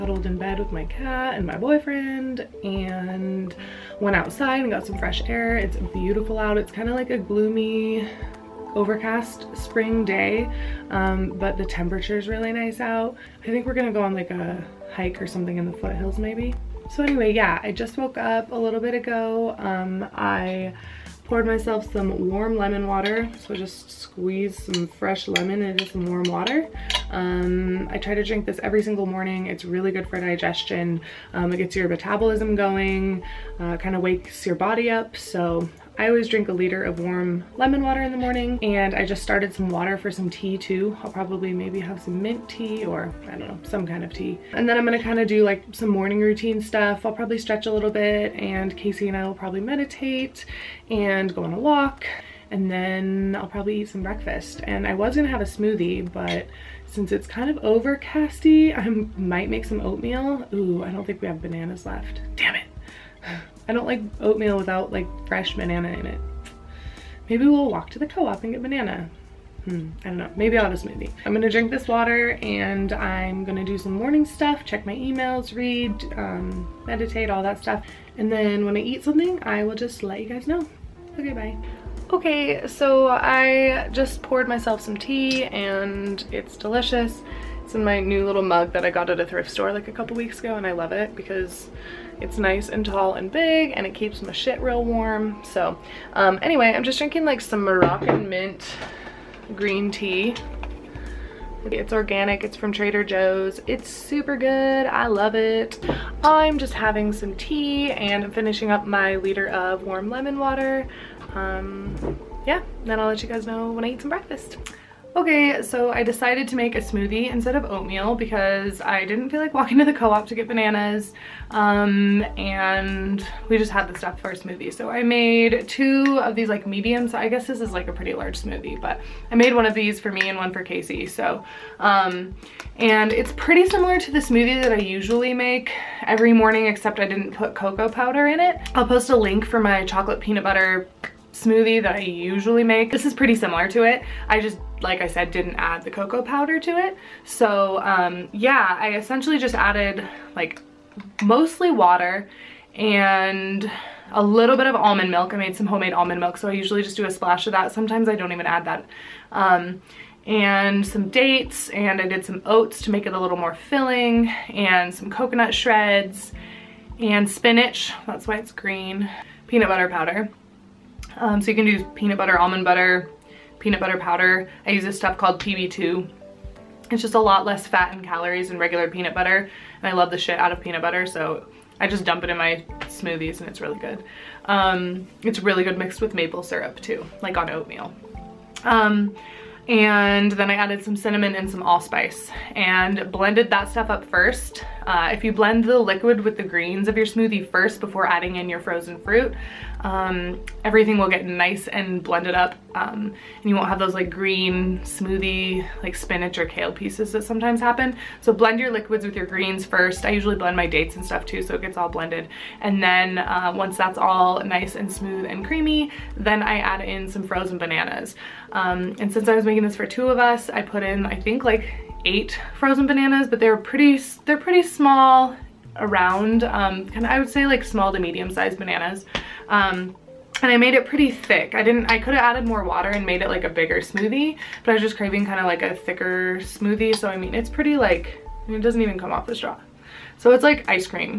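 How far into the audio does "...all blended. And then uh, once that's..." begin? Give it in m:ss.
3:31.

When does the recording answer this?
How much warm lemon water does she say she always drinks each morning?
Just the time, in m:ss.
0:36.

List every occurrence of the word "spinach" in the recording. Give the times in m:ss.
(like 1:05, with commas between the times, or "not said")
2:47, 3:25.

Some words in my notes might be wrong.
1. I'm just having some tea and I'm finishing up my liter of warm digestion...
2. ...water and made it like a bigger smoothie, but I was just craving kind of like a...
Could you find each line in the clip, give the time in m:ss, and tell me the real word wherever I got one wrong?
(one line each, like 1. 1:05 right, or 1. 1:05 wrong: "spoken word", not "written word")
1. 1:46 wrong: "lemon", not "digestion"
2. 3:52 right.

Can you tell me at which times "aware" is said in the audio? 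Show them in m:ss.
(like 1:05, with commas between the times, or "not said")
not said.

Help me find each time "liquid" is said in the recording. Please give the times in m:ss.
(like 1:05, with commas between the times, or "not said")
3:15, 3:28.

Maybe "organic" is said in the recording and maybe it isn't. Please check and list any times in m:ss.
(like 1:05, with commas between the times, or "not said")
1:41.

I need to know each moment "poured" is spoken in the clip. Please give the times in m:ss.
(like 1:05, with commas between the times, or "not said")
0:21, 1:24.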